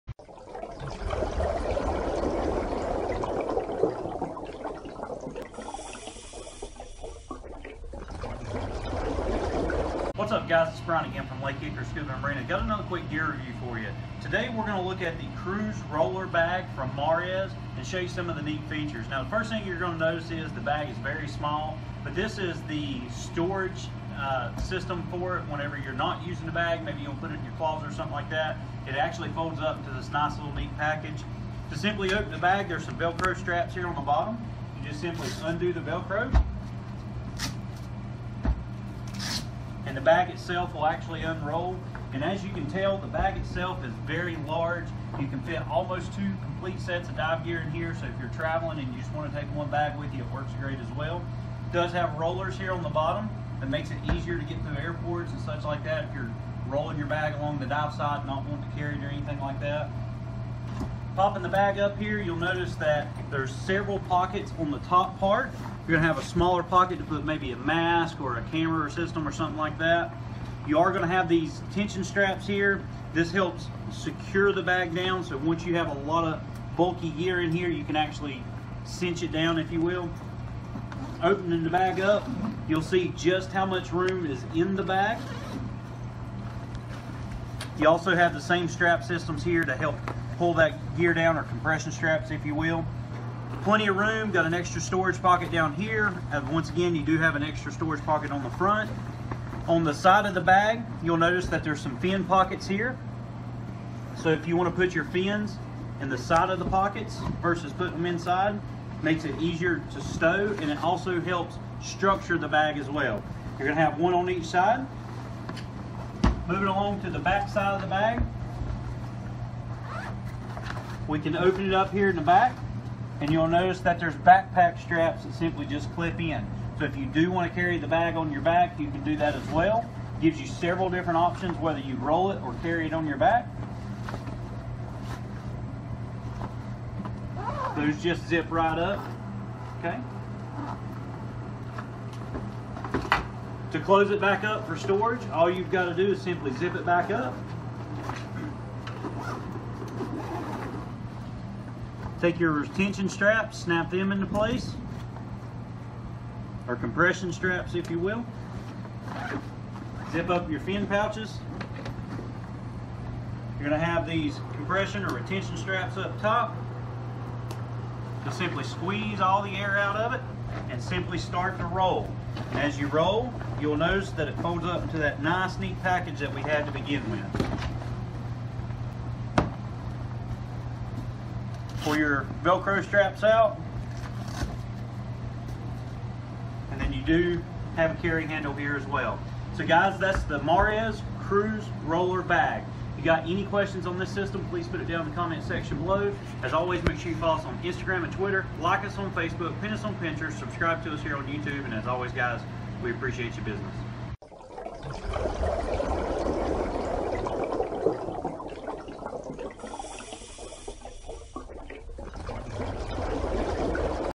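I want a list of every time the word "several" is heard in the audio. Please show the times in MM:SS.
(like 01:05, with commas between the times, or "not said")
01:03, 02:10.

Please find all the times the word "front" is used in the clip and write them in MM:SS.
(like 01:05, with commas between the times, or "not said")
01:38.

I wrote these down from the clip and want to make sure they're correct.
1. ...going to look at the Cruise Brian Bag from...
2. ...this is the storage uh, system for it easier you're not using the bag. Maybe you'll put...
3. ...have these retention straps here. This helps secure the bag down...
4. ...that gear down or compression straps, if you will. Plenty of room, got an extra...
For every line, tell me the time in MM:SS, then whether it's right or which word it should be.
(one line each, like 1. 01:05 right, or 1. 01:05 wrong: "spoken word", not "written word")
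1. 00:14 wrong: "Roller", not "Brian"
2. 00:22 wrong: "whenever", not "easier"
3. 01:11 wrong: "tension", not "retention"
4. 01:30 right.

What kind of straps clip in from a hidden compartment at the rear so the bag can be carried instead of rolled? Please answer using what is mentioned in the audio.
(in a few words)
Backpack straps.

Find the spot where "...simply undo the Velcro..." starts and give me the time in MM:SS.
00:35.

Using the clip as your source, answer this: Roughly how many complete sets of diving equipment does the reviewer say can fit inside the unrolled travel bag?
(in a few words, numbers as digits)
2.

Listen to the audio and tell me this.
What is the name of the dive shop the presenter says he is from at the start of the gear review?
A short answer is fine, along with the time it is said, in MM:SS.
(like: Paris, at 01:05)
Lake Hickory Scuba Marina, at 00:11.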